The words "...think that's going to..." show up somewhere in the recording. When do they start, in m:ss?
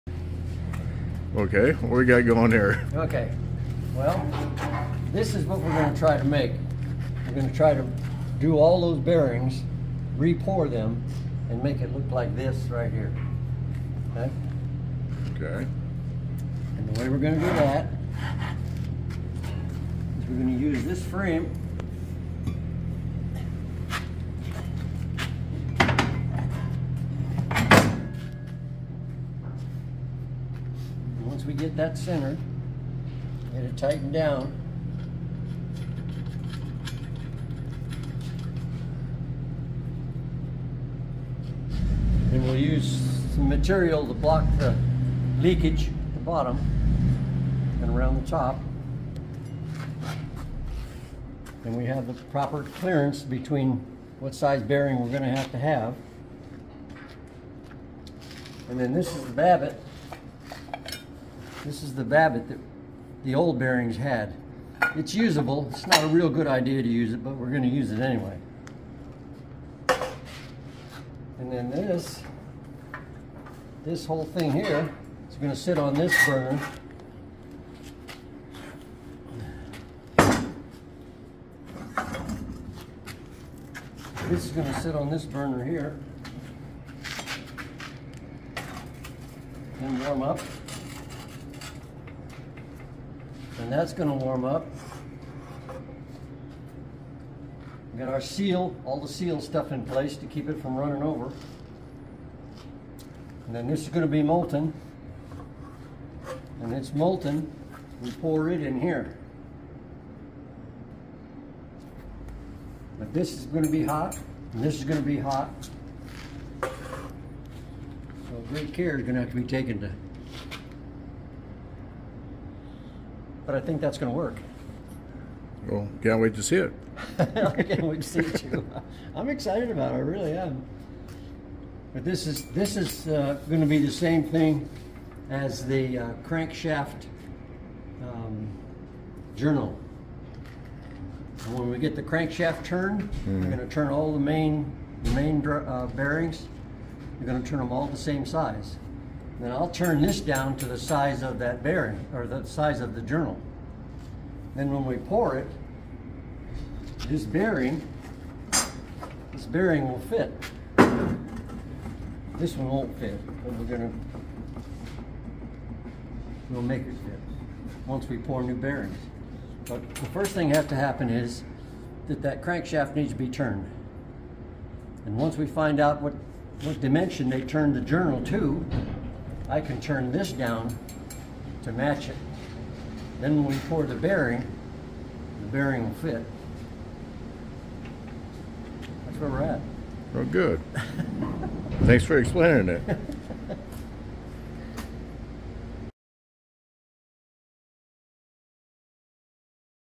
2:03.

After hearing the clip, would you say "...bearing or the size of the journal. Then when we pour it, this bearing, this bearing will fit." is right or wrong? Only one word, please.
right.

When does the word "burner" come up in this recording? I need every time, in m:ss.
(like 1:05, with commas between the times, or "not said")
1:16, 1:25.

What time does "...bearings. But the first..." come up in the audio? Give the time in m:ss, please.
2:48.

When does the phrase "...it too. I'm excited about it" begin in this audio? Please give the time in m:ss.
2:08.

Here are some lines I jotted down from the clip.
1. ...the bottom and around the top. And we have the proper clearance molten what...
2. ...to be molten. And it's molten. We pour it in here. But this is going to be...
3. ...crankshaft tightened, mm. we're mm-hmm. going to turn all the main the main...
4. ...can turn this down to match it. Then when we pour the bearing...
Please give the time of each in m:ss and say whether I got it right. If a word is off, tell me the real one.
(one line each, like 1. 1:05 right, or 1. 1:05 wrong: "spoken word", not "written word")
1. 0:46 wrong: "between", not "molten"
2. 1:44 right
3. 2:22 wrong: "turned", not "tightened"
4. 2:59 right.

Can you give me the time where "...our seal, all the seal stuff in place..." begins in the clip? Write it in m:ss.
1:38.